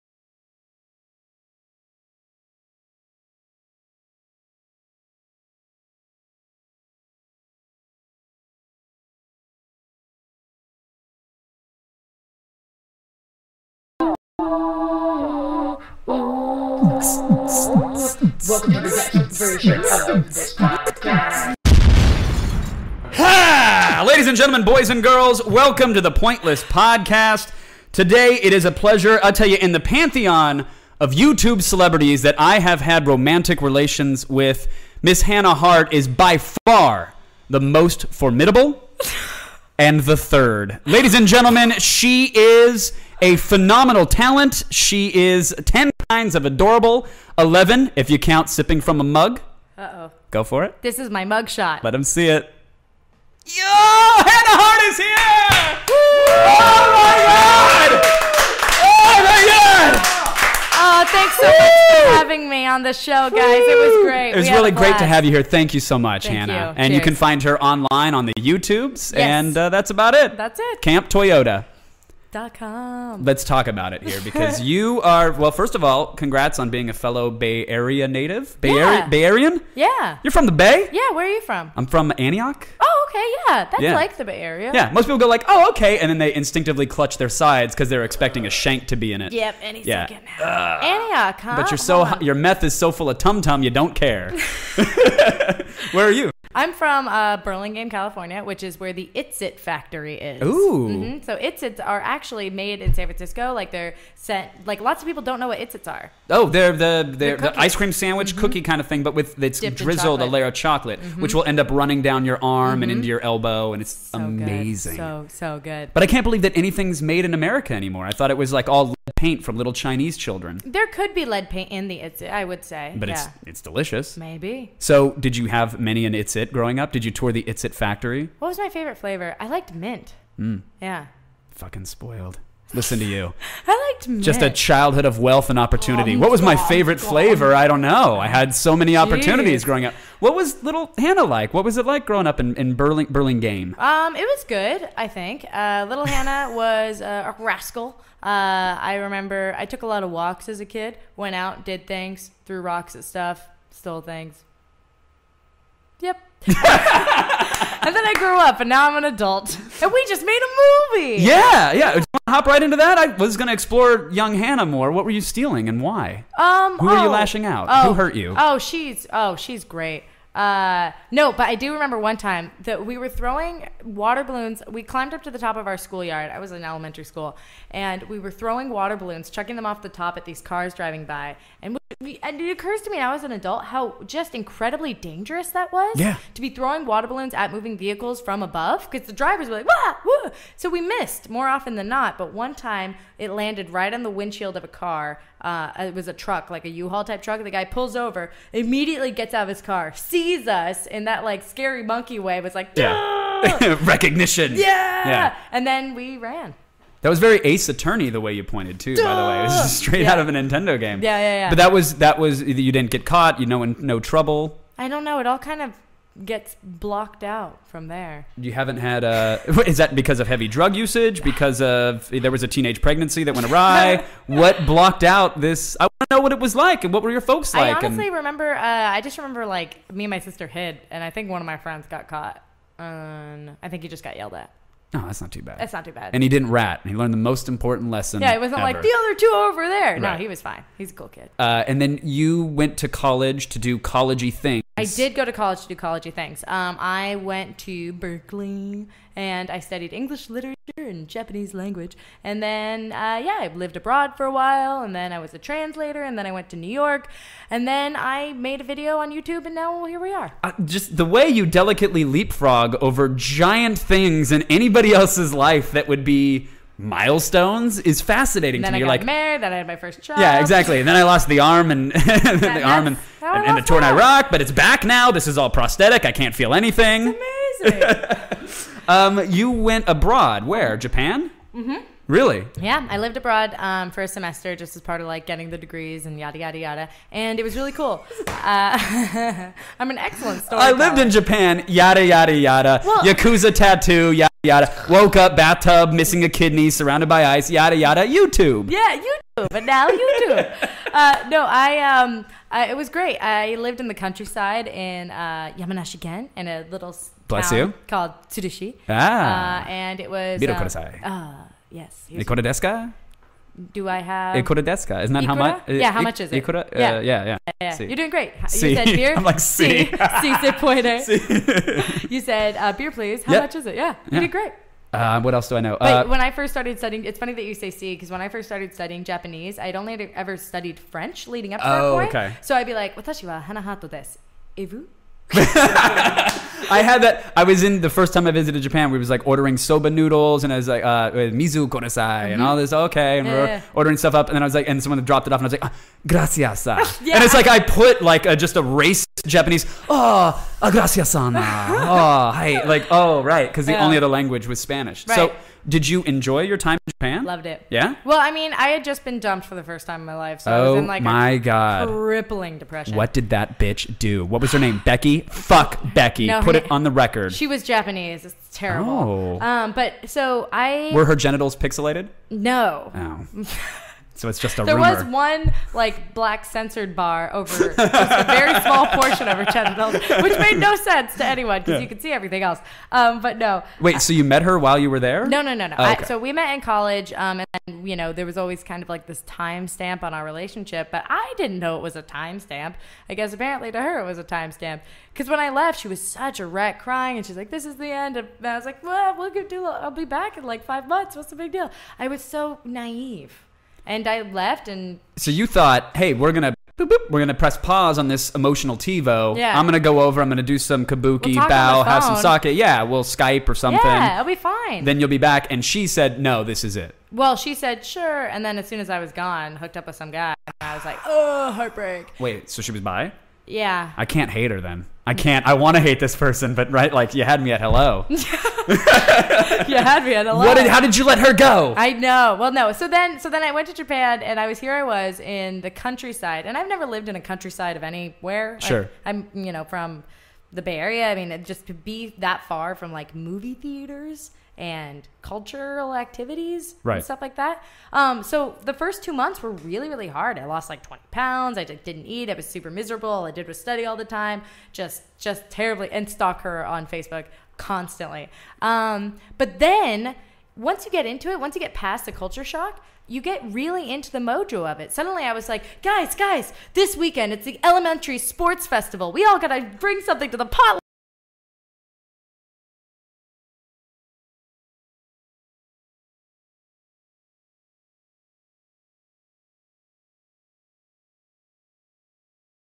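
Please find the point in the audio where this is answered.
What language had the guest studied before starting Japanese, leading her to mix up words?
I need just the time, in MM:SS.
05:30.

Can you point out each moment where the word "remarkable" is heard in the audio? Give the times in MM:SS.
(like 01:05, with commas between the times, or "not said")
not said.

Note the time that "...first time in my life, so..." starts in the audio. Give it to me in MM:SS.
05:59.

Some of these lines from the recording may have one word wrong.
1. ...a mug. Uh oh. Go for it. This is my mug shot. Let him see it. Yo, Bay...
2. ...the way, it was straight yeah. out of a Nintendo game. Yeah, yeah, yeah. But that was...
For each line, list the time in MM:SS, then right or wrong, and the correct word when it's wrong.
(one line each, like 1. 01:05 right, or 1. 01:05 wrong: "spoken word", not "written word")
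1. 00:48 wrong: "Hannah", not "Bay"
2. 03:29 right.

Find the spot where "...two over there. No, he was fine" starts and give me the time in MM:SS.
03:59.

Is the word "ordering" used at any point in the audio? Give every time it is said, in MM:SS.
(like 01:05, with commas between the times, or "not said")
05:39, 05:43.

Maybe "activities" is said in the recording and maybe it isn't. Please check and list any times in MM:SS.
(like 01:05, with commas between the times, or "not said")
07:25.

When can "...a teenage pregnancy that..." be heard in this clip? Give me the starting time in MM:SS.
03:42.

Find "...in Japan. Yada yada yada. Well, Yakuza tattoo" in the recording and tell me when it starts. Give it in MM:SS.
04:50.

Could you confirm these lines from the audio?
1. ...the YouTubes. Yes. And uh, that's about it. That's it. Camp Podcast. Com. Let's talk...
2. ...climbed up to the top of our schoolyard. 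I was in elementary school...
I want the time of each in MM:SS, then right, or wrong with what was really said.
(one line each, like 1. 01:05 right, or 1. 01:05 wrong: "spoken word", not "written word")
1. 01:08 wrong: "Toyota", not "Podcast"
2. 02:54 right.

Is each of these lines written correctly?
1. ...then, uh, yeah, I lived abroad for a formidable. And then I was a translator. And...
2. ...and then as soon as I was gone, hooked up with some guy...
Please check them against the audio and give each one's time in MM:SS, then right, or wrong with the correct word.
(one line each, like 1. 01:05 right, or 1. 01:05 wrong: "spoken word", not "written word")
1. 04:12 wrong: "while", not "formidable"
2. 06:58 right.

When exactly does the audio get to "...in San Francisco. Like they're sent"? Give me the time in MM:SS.
01:42.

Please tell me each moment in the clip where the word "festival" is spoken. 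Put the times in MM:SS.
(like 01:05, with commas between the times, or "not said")
07:48.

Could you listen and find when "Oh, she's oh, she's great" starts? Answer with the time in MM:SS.
02:48.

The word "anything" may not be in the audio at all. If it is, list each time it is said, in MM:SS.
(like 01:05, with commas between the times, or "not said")
01:56, 04:36.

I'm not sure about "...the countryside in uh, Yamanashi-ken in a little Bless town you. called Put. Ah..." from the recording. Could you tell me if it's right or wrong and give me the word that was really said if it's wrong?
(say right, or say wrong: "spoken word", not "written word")
wrong: "Tsurushi", not "Put".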